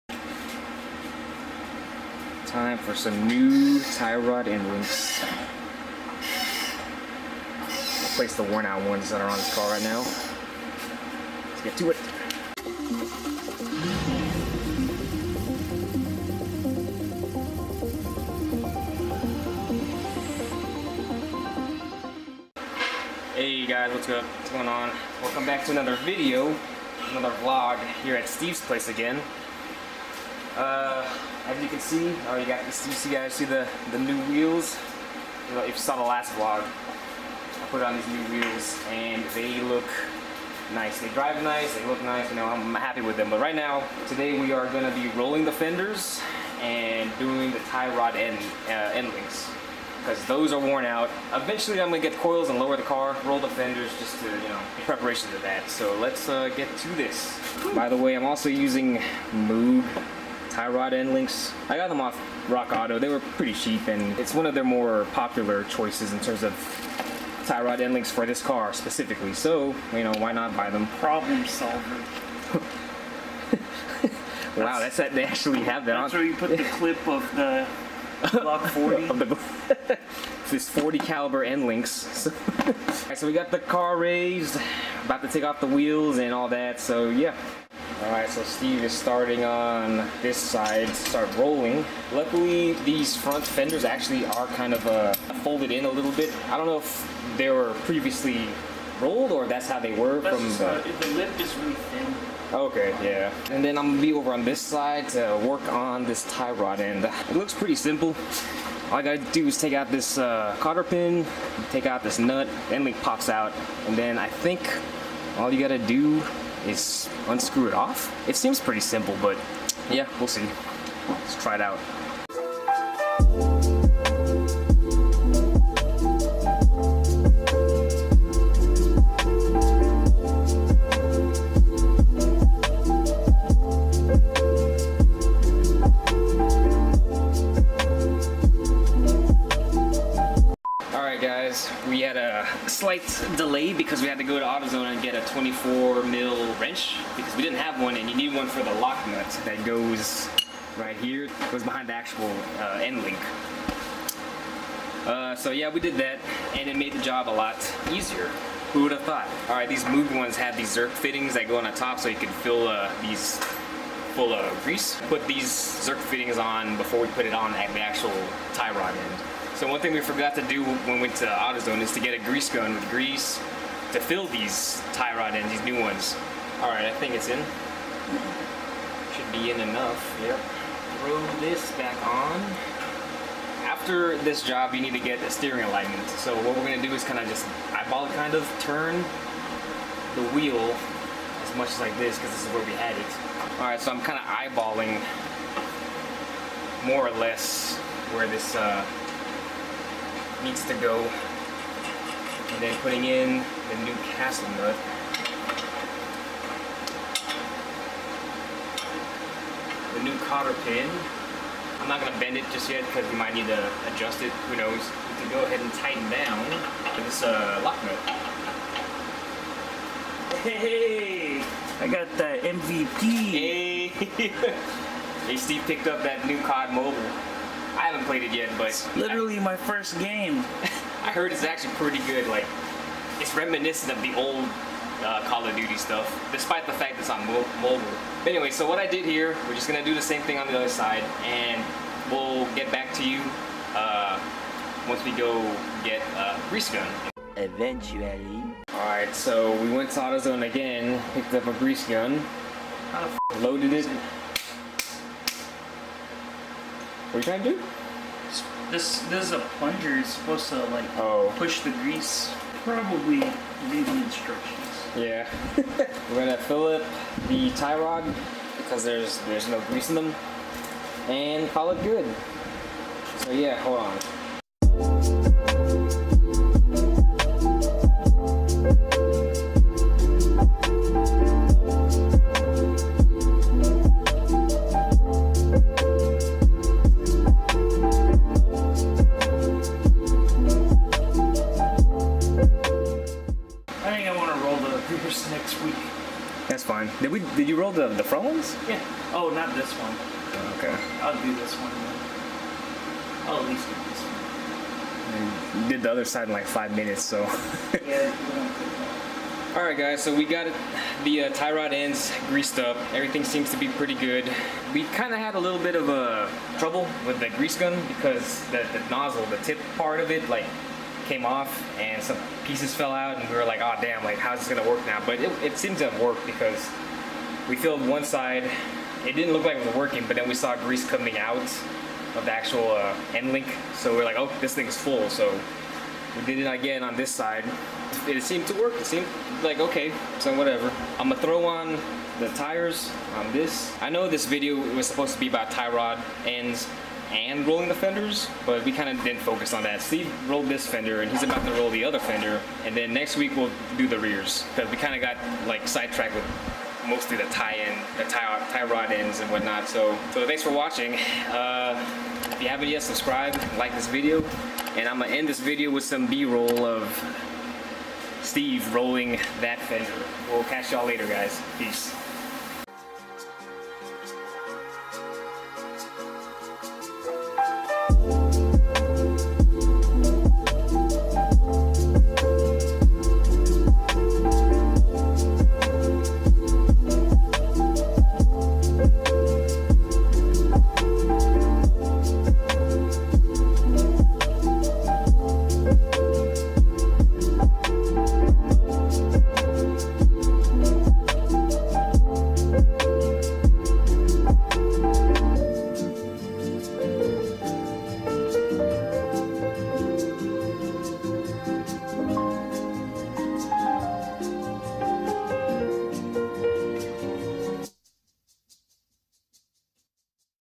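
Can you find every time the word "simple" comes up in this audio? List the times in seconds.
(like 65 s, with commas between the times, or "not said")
107 s, 118 s.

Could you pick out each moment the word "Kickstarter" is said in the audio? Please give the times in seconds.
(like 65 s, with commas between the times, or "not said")
not said.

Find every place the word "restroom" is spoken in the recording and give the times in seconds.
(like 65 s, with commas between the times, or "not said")
not said.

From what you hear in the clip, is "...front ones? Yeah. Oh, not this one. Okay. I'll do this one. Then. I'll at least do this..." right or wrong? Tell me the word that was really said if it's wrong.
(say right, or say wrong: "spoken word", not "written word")
right.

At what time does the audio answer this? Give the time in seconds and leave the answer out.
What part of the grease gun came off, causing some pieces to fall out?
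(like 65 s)
318 s.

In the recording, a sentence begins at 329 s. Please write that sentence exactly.
It didn't look like it was working, but then we saw grease coming out of the actual uh, end link.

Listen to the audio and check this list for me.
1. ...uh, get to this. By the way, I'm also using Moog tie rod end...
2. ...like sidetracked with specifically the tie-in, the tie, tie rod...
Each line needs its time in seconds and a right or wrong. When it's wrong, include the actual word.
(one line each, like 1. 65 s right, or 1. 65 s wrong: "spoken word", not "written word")
1. 56 s right
2. 355 s wrong: "mostly", not "specifically".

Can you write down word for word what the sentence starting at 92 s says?
Luckily, these front fenders actually are kind of uh, folded in a little bit.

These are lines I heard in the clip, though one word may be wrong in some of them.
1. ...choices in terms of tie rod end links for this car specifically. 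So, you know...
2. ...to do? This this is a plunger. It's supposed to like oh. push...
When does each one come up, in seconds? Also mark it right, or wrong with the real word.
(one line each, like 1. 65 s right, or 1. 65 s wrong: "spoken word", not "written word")
1. 65 s right
2. 257 s right.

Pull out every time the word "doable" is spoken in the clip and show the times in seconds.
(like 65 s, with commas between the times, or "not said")
not said.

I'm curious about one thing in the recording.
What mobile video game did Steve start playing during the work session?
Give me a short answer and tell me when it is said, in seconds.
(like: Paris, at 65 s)
COD Mobile, at 226 s.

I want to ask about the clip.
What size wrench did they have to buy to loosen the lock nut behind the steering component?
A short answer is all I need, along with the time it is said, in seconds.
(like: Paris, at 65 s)
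24 mm, at 145 s.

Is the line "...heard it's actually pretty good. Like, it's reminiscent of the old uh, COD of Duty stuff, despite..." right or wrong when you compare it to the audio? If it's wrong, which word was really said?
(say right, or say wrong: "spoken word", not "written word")
wrong: "Call", not "COD".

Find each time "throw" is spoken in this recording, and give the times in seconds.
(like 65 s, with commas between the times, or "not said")
181 s, 341 s.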